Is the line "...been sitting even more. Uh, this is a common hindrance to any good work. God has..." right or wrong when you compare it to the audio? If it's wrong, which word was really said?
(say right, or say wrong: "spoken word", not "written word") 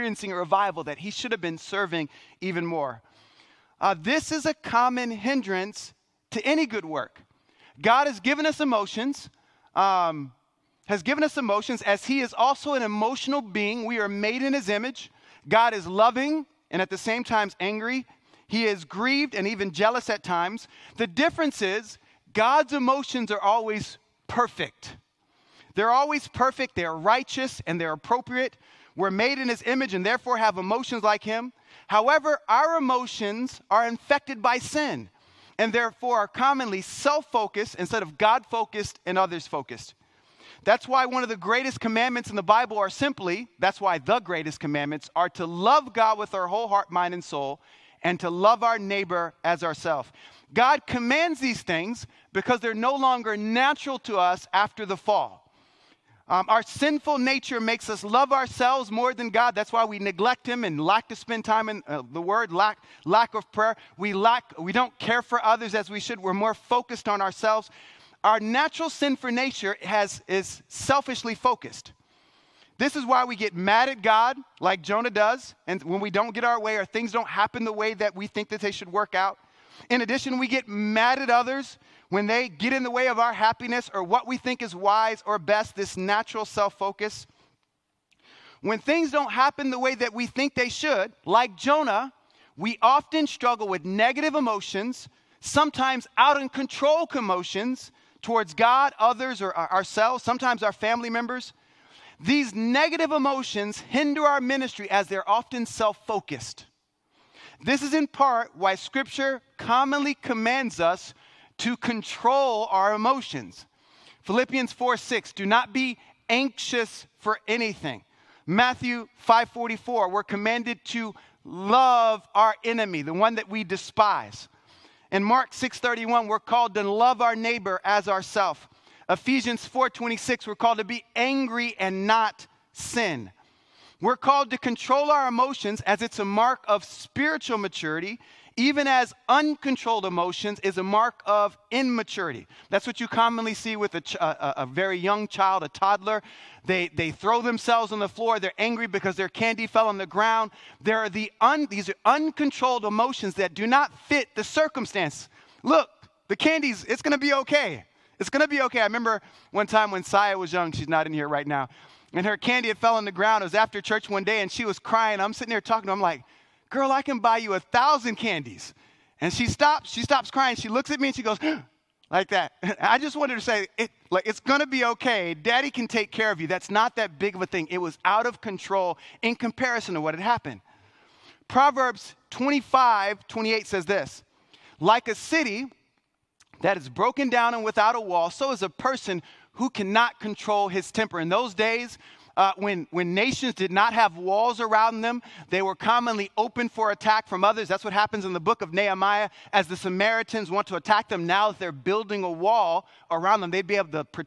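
wrong: "serving", not "sitting".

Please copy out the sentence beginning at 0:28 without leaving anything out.
We're made in his image and therefore have emotions like him.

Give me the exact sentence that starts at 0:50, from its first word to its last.
God commands these things because they're no longer natural to us after the fall.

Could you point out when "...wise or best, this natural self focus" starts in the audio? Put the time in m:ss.
1:24.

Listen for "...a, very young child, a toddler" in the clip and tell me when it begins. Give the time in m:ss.
2:24.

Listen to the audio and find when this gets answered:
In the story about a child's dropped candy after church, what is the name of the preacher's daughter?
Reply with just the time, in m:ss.
2:40.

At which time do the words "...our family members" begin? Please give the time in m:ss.
1:40.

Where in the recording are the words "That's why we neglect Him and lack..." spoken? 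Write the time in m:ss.
0:59.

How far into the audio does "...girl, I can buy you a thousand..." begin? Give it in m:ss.
2:46.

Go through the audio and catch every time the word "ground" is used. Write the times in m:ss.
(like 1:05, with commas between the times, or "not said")
2:30, 2:43.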